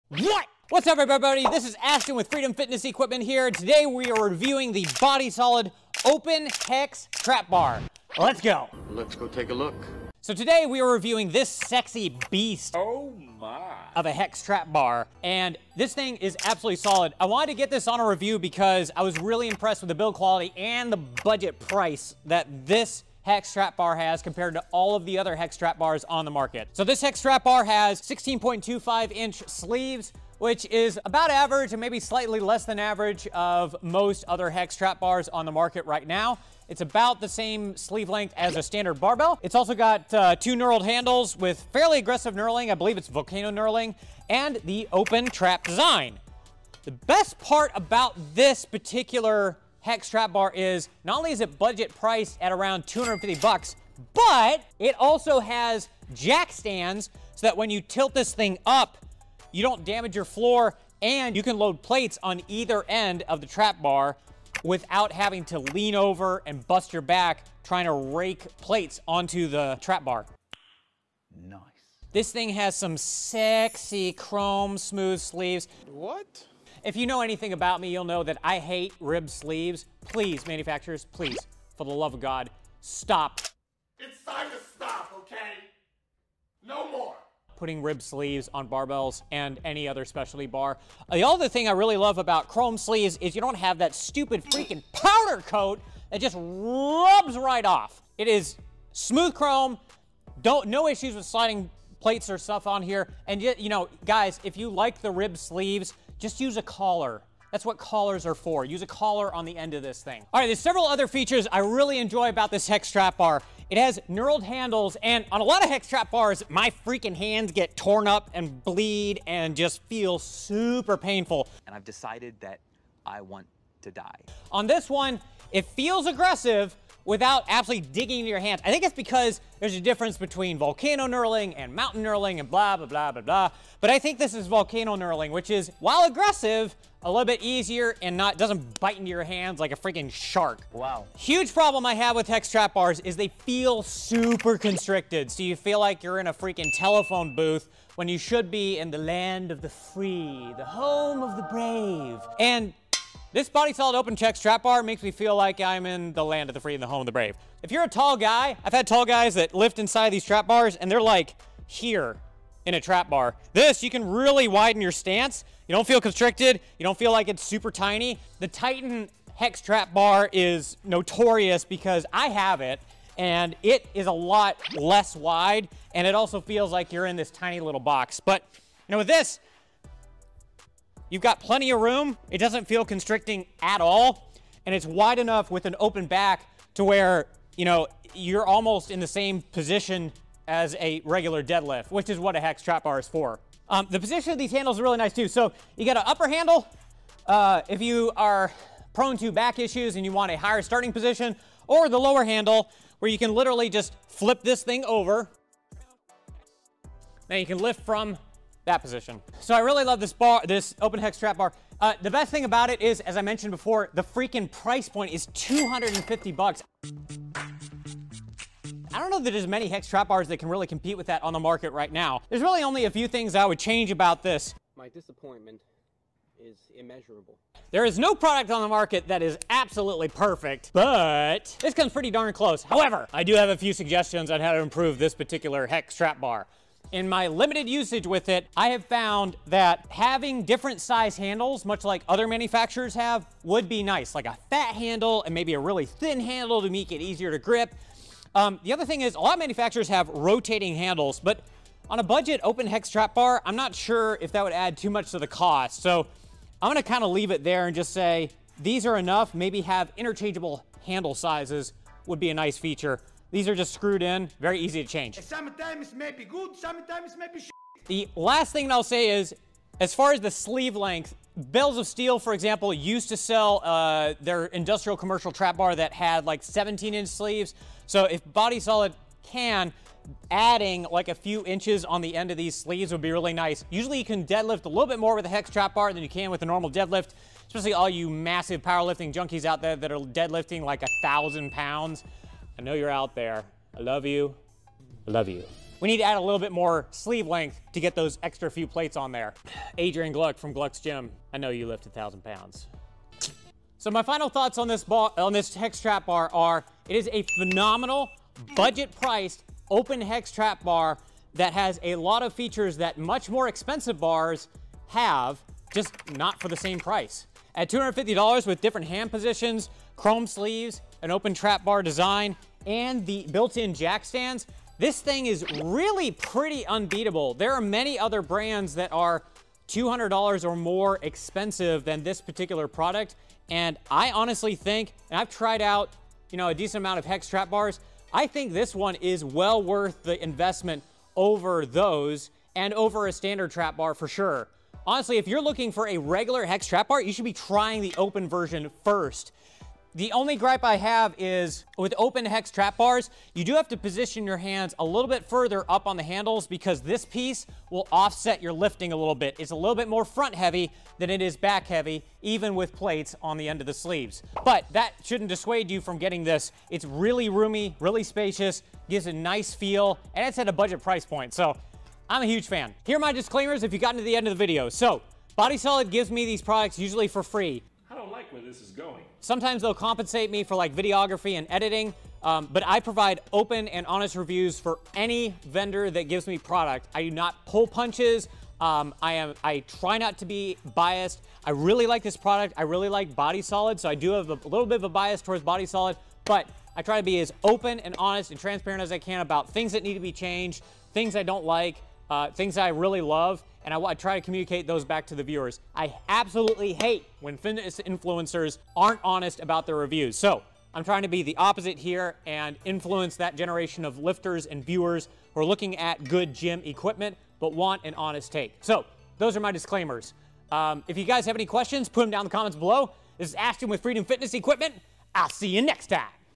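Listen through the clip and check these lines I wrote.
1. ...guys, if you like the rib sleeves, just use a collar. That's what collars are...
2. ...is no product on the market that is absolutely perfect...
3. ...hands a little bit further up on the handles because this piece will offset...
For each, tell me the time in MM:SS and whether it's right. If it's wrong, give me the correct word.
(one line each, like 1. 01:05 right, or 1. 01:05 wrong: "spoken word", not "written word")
1. 01:44 right
2. 03:47 right
3. 05:54 right.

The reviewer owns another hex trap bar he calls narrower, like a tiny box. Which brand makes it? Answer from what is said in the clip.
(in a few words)
Titan.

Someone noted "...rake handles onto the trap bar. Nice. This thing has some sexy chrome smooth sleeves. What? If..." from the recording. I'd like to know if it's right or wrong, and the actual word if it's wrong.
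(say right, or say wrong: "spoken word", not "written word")
wrong: "plates", not "handles".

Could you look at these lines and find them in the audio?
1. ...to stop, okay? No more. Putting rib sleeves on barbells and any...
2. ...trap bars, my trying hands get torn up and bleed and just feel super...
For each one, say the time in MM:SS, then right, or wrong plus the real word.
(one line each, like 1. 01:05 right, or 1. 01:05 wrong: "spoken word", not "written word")
1. 01:24 right
2. 01:55 wrong: "freaking", not "trying".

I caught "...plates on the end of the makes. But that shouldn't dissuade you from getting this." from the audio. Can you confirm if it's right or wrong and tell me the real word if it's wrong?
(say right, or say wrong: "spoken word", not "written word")
wrong: "sleeves", not "makes".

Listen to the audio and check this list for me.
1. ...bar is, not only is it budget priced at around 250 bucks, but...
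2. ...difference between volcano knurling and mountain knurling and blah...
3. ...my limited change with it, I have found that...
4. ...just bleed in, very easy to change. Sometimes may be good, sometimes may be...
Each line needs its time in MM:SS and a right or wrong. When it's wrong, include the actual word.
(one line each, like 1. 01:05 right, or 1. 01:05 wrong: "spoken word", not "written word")
1. 00:50 right
2. 02:09 right
3. 03:57 wrong: "usage", not "change"
4. 04:23 wrong: "screwed", not "bleed".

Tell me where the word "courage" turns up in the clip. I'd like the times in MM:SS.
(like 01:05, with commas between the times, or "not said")
not said.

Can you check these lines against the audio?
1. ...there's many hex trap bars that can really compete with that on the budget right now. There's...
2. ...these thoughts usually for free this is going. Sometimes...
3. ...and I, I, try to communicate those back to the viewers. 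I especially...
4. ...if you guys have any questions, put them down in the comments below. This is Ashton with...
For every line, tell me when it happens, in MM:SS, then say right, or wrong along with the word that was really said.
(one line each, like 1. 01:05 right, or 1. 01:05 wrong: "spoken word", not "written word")
1. 03:39 wrong: "market", not "budget"
2. 06:16 wrong: "products", not "thoughts"
3. 06:43 wrong: "absolutely", not "especially"
4. 07:00 right.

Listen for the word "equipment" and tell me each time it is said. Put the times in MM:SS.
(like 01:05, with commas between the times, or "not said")
00:02, 06:56, 07:04.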